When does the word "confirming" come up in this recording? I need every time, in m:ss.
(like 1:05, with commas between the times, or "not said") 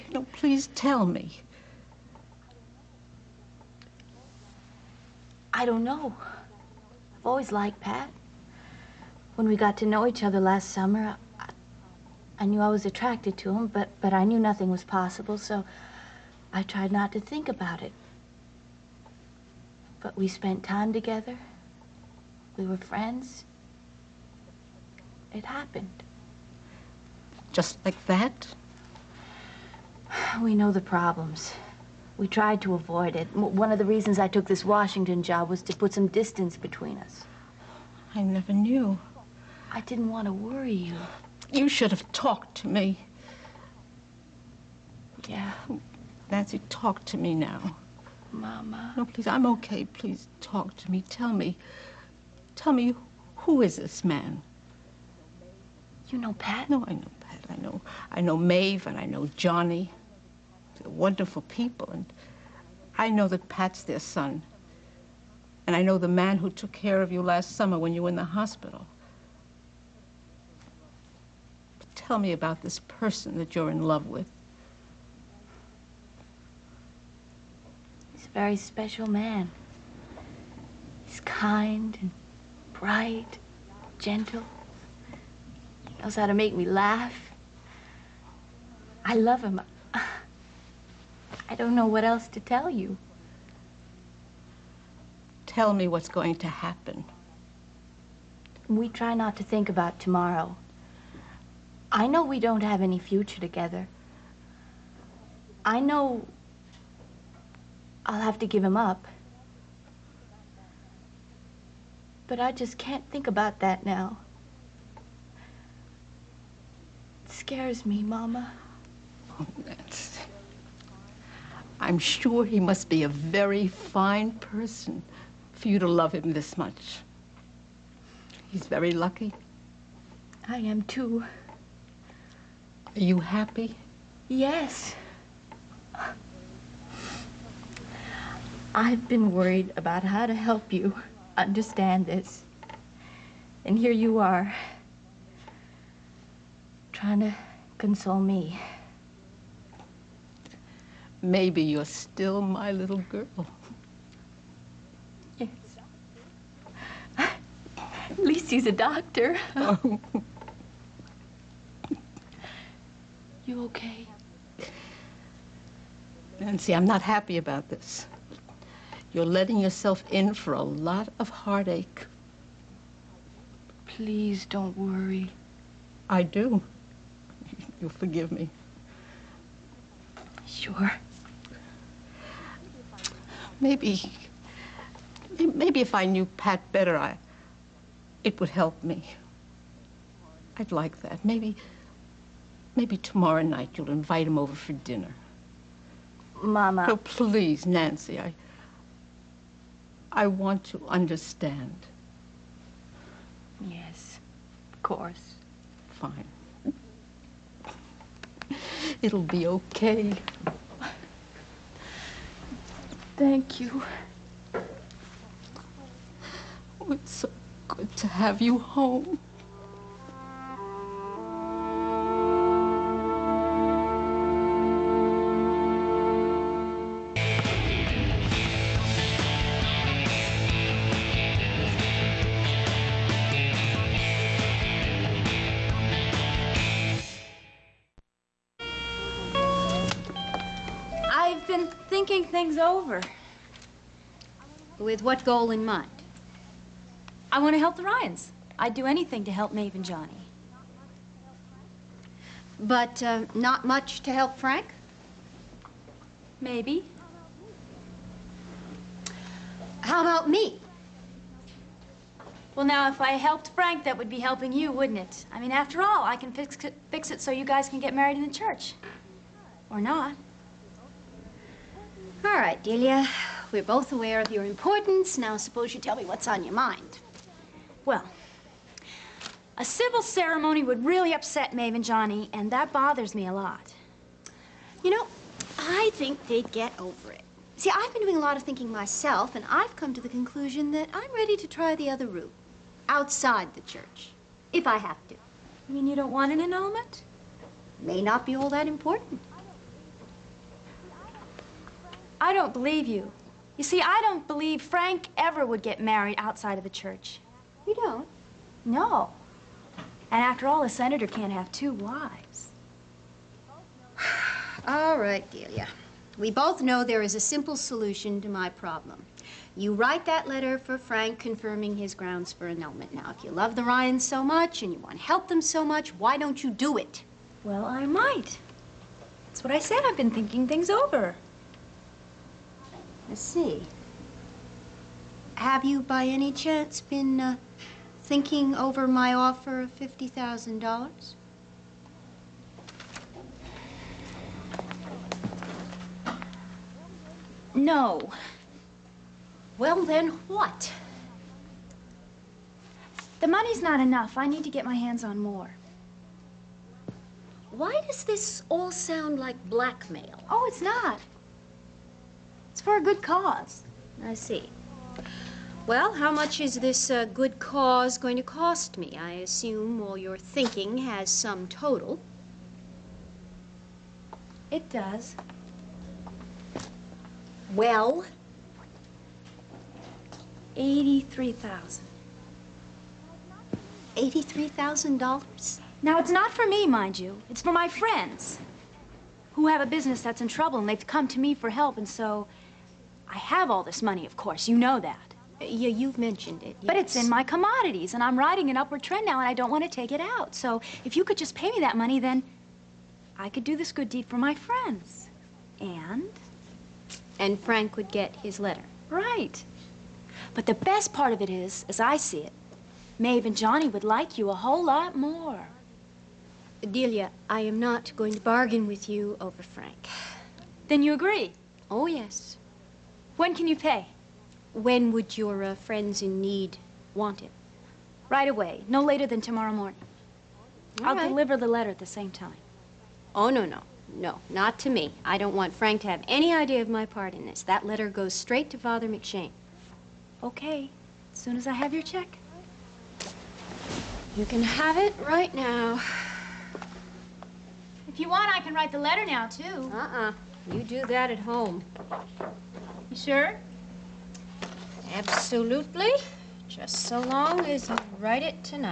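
5:21.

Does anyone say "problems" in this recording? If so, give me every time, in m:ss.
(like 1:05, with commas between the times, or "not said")
0:30, 5:18.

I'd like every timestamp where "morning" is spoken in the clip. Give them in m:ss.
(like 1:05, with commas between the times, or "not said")
7:09.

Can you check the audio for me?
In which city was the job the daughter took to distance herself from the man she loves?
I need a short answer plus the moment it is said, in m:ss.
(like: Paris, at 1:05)
Washington, at 0:34.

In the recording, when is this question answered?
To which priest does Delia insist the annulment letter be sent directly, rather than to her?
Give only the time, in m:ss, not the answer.
7:18.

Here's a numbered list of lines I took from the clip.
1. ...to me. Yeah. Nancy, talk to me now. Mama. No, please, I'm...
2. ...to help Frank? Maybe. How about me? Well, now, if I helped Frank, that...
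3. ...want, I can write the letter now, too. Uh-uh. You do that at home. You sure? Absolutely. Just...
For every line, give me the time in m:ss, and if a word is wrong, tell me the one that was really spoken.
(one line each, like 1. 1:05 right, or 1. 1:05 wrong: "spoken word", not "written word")
1. 0:42 right
2. 4:14 right
3. 7:28 right.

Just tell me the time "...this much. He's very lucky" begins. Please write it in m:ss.
2:06.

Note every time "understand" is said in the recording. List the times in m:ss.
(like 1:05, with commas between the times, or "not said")
2:21, 3:20.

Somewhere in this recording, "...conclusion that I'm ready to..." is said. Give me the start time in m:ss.
4:50.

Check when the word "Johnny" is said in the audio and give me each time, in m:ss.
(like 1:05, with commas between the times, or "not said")
0:59, 4:09, 4:41, 6:53.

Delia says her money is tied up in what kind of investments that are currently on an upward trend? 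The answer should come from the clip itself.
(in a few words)
Commodities.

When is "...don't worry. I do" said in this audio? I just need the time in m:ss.
2:54.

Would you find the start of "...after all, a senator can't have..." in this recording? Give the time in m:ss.
5:10.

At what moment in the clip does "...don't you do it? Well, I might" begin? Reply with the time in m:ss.
5:26.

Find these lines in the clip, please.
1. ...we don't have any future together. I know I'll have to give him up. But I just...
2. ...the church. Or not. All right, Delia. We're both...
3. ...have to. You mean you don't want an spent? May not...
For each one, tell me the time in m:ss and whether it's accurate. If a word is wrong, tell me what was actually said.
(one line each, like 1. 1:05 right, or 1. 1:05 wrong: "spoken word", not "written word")
1. 1:42 right
2. 4:28 right
3. 4:54 wrong: "annulment", not "spent".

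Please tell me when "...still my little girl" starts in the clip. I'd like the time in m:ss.
2:31.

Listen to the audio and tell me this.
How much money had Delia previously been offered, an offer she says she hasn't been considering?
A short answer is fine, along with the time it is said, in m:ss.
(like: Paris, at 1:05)
$50,000, at 5:39.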